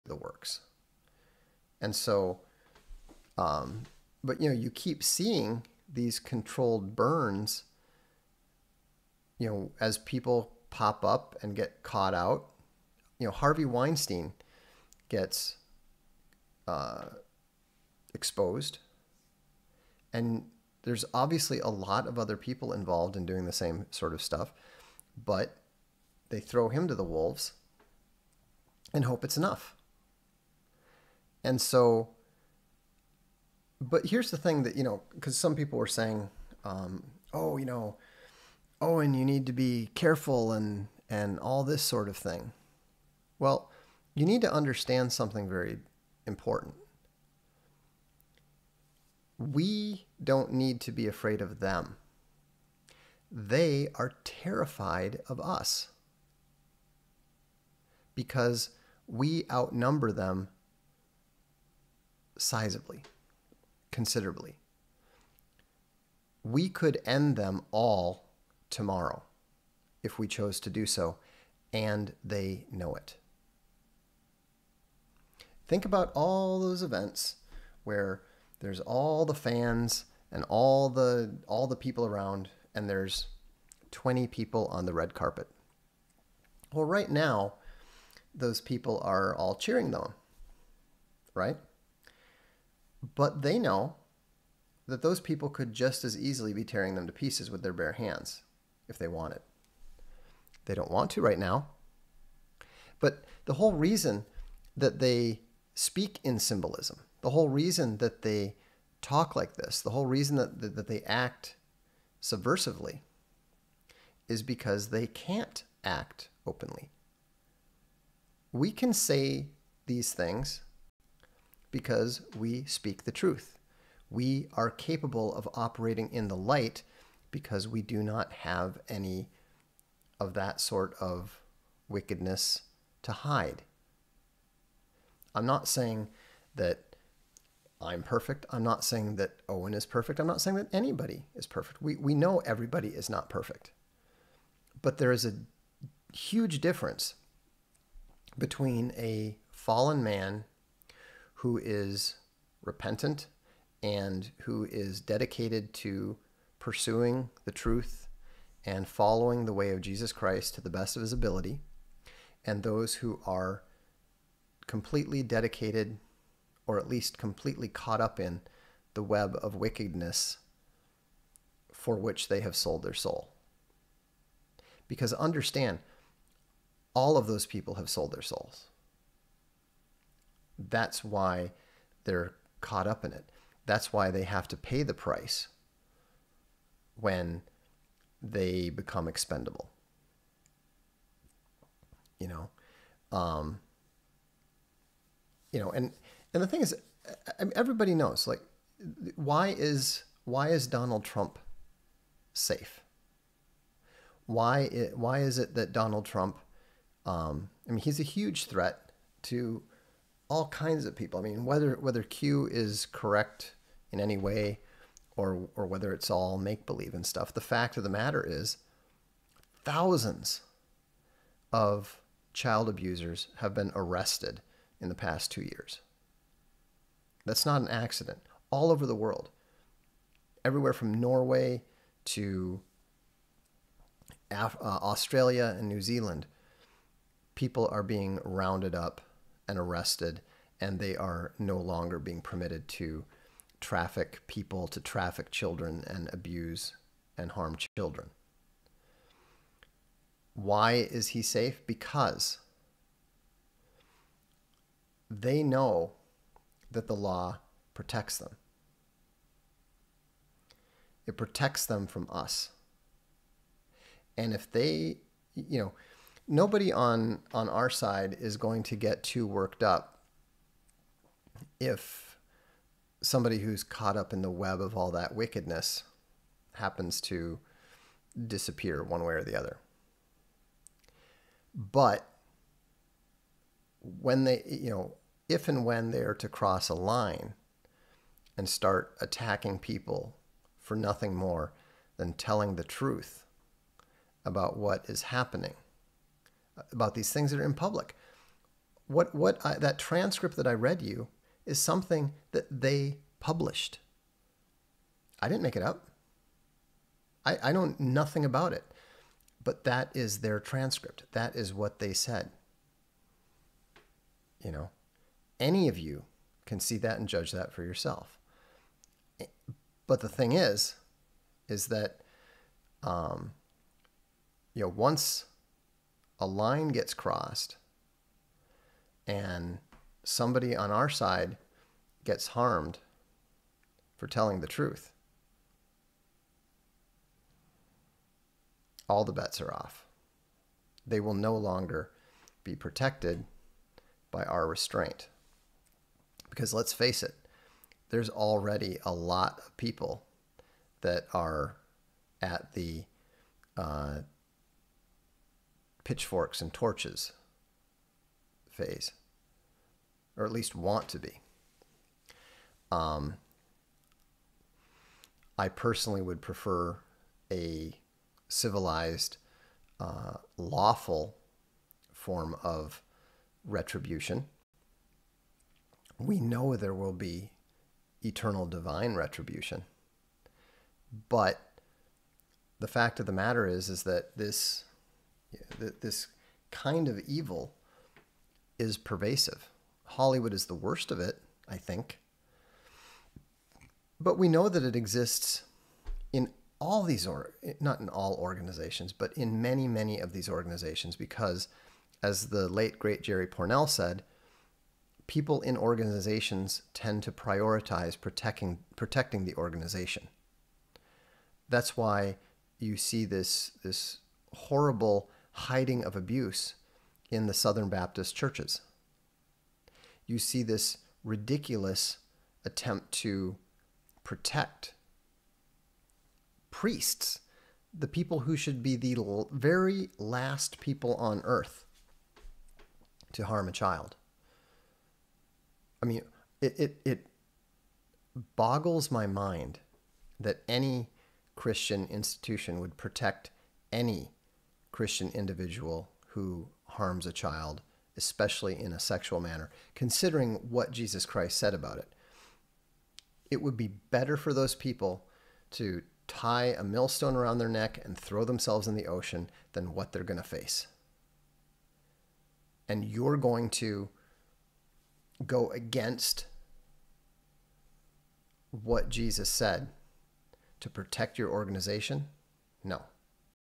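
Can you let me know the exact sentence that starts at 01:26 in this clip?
Well, right now those people are all cheering them, right?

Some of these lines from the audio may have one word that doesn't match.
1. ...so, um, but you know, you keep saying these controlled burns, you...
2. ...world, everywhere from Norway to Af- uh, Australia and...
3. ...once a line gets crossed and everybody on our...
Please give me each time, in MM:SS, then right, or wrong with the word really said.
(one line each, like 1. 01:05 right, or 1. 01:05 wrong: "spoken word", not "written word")
1. 00:01 wrong: "seeing", not "saying"
2. 03:48 right
3. 05:24 wrong: "somebody", not "everybody".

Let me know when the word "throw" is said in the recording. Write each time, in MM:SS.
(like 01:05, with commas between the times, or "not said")
00:26, 07:37.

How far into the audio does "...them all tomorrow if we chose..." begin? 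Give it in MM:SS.
01:07.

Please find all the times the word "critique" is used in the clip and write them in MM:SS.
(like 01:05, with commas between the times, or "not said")
not said.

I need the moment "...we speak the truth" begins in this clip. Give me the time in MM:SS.
02:02.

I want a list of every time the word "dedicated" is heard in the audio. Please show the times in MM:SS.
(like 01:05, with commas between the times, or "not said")
02:35, 02:45.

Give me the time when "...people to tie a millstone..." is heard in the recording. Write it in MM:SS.
07:34.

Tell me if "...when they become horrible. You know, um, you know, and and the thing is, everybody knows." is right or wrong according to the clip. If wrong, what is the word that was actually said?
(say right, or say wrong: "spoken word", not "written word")
wrong: "expendable", not "horrible".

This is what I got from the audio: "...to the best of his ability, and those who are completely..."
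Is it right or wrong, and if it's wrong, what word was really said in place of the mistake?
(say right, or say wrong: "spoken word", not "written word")
right.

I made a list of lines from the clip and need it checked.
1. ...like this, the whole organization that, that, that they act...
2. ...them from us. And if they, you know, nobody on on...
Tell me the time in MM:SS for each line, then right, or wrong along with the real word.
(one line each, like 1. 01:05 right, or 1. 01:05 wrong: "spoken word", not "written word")
1. 01:49 wrong: "reason", not "organization"
2. 04:21 right.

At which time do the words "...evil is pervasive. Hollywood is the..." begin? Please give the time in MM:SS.
06:27.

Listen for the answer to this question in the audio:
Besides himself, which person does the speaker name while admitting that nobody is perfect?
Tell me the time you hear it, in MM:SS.
02:19.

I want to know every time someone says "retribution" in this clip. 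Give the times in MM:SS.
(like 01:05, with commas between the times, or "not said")
06:13, 06:18.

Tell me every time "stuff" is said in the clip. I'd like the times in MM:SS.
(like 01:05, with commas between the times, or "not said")
00:24, 03:37.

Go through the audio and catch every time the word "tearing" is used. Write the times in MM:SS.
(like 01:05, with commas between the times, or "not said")
01:36.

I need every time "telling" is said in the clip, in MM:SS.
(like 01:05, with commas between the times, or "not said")
04:52, 05:34.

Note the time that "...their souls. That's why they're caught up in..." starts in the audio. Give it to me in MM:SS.
02:58.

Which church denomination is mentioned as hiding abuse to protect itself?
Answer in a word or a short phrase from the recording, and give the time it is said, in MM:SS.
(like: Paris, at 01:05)
Southern Baptist, at 06:57.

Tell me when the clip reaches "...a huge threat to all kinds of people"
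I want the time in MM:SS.
03:27.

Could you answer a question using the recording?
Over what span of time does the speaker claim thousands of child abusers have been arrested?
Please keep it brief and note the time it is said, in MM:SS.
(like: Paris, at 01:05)
Two years, at 03:45.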